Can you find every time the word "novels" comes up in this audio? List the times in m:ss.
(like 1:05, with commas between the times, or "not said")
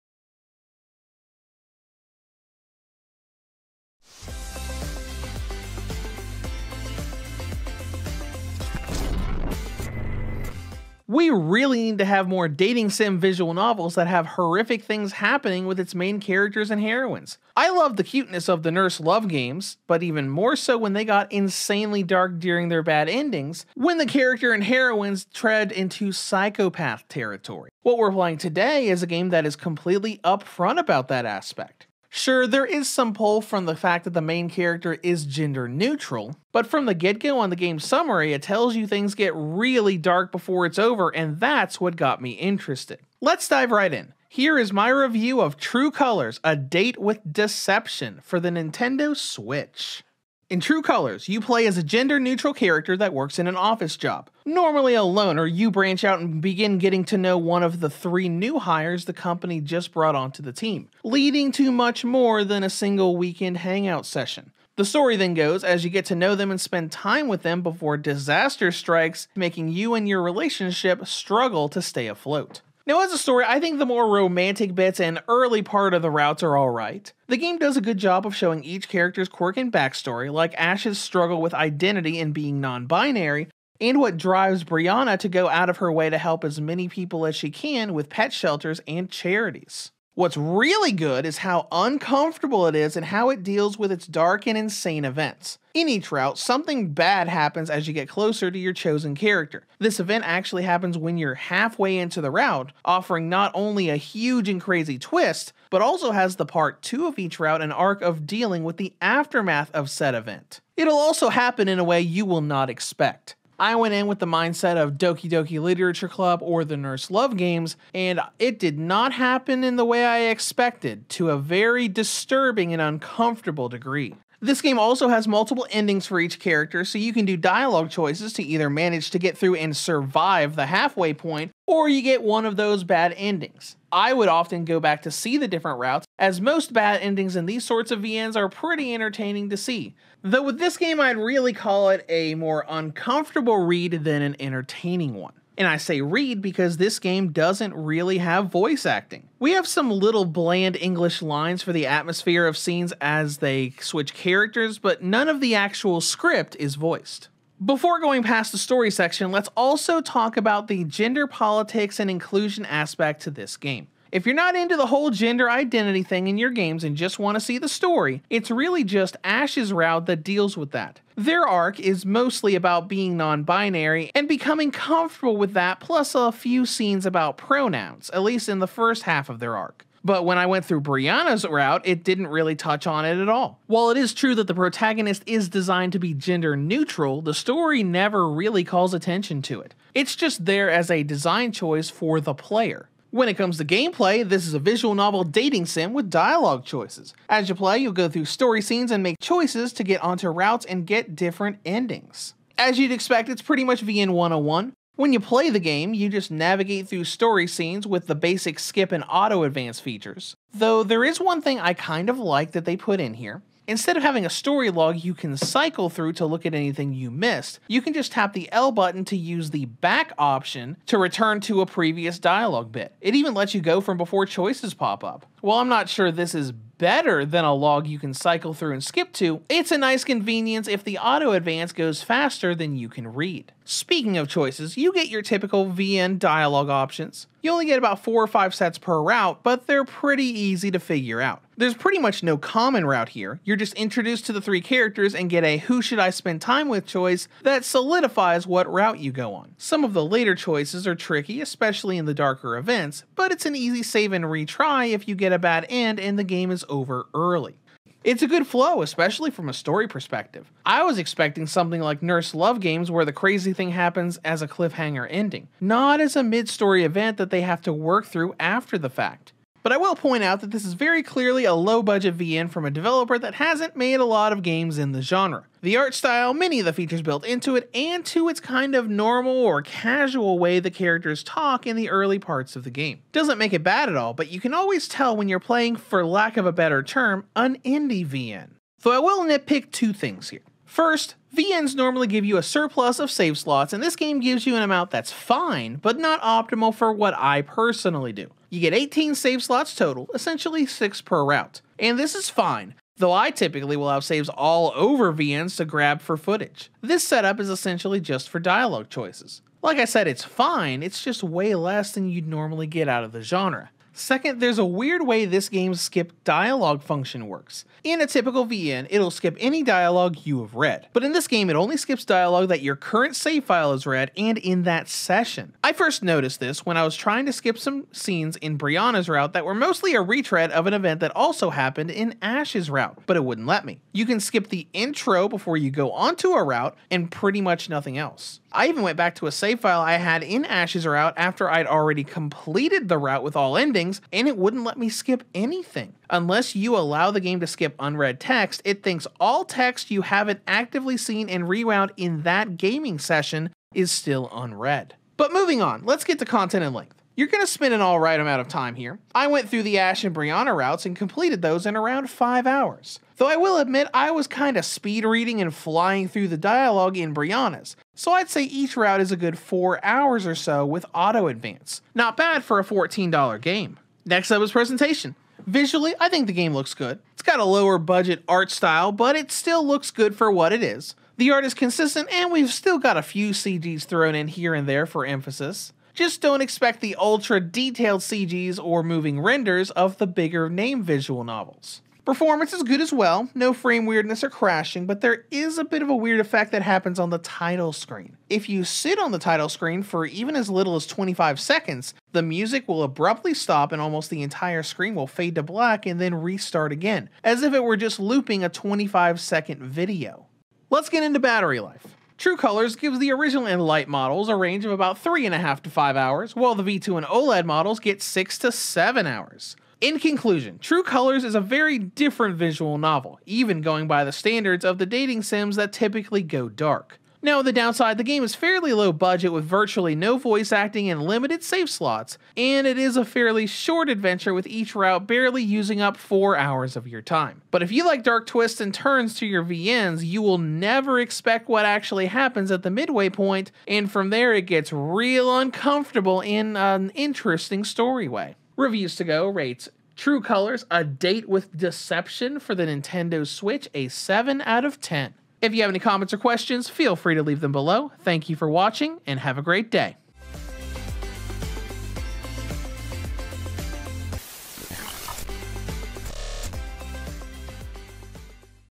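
0:13, 3:14, 6:31, 7:02.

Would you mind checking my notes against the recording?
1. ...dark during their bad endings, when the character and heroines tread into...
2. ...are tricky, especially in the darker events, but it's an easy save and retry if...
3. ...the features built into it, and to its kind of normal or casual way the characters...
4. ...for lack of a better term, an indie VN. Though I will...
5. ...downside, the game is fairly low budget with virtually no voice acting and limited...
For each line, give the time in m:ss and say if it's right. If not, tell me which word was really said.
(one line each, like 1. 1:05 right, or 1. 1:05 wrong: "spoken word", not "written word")
1. 0:22 right
2. 4:10 right
3. 4:36 right
4. 4:45 right
5. 7:07 right.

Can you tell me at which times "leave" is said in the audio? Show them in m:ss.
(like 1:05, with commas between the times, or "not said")
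7:37.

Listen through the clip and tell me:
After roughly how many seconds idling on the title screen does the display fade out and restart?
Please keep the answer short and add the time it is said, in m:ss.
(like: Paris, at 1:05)
25, at 6:40.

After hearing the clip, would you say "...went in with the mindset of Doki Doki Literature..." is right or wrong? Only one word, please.
right.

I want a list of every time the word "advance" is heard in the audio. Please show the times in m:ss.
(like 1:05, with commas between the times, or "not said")
3:29, 3:51, 6:11.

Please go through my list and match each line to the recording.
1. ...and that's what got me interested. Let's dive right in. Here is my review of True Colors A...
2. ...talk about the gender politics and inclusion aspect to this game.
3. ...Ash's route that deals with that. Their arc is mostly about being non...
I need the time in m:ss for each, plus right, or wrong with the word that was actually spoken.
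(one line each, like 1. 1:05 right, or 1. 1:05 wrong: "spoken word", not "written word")
1. 0:41 right
2. 2:40 right
3. 2:49 right.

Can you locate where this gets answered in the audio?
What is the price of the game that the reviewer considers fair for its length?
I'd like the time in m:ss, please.
6:12.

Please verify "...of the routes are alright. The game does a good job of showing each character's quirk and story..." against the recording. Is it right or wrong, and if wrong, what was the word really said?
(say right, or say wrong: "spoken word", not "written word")
wrong: "backstory", not "story".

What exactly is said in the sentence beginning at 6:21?
The art is consistent, and we've still got a few CGs thrown in here and there for emphasis.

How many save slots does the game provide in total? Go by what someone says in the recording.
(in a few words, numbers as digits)
18.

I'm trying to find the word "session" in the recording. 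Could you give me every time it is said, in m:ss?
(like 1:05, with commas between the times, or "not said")
1:04, 5:24, 5:52.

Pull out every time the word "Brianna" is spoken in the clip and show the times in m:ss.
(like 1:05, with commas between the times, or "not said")
1:24, 3:00, 5:28, 6:00, 6:07.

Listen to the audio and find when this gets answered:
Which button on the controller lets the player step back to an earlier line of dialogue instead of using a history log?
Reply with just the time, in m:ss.
3:38.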